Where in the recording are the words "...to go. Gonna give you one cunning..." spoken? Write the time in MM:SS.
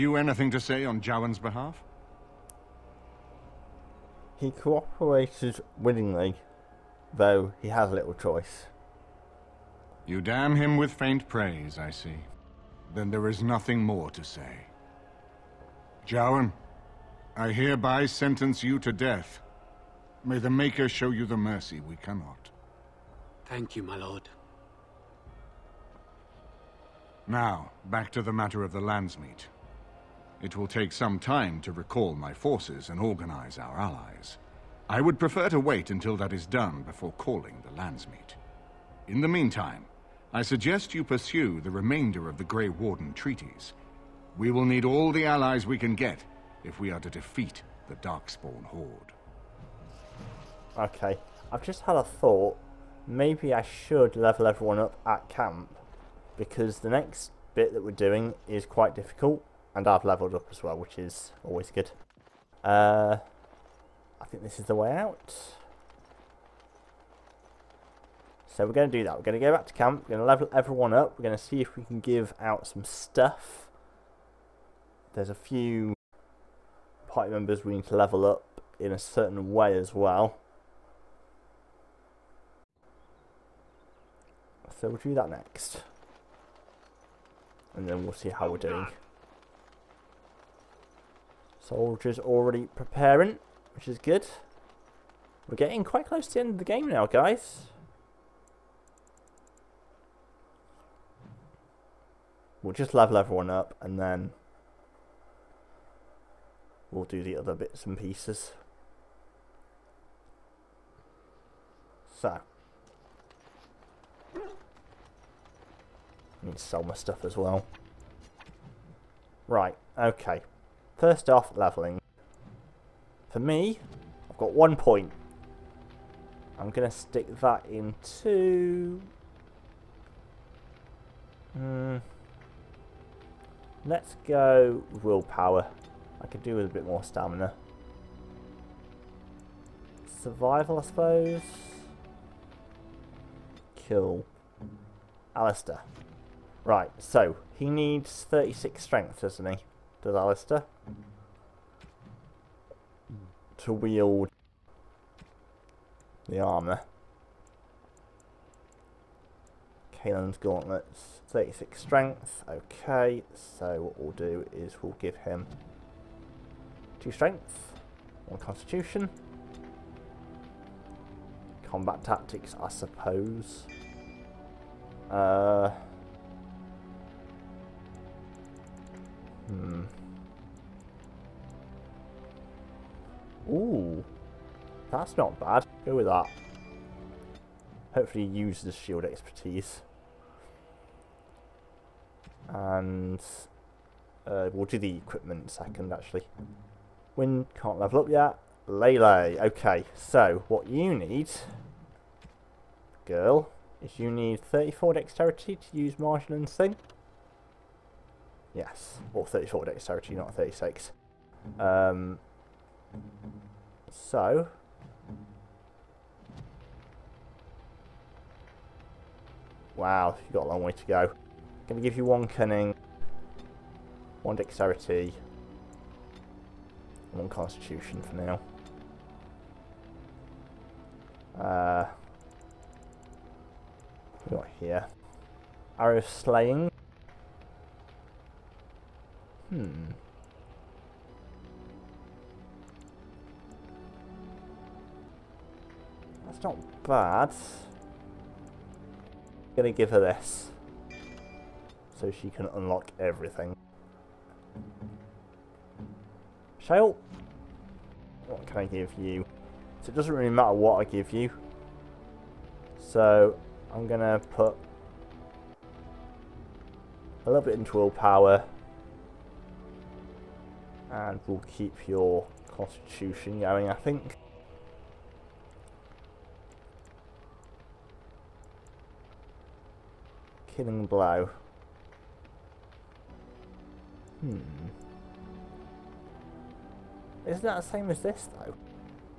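03:40.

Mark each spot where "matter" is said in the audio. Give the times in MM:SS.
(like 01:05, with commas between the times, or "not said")
00:28, 04:20.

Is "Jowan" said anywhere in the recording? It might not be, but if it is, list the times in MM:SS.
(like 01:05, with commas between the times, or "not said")
00:01, 00:16.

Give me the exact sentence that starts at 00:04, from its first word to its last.
He cooperated willingly, though he has little choice.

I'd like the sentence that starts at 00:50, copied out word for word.
Okay, I've just had a thought.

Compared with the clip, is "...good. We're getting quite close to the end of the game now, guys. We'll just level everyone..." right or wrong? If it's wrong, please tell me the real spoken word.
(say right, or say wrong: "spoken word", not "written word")
right.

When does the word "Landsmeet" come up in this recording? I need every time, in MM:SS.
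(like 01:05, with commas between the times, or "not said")
00:28, 00:37.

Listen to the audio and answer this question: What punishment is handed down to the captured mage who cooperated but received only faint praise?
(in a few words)
Death.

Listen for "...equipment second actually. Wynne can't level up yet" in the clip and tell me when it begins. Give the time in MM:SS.
03:14.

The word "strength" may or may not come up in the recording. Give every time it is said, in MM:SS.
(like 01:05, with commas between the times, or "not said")
02:28, 02:41, 02:47.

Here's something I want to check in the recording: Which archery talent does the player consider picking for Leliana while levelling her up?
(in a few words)
Arrow Slaying.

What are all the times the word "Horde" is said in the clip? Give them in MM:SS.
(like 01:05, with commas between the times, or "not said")
00:48.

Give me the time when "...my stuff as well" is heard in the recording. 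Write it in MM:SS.
01:56.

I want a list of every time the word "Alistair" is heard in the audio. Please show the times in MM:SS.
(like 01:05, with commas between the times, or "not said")
02:25, 02:30.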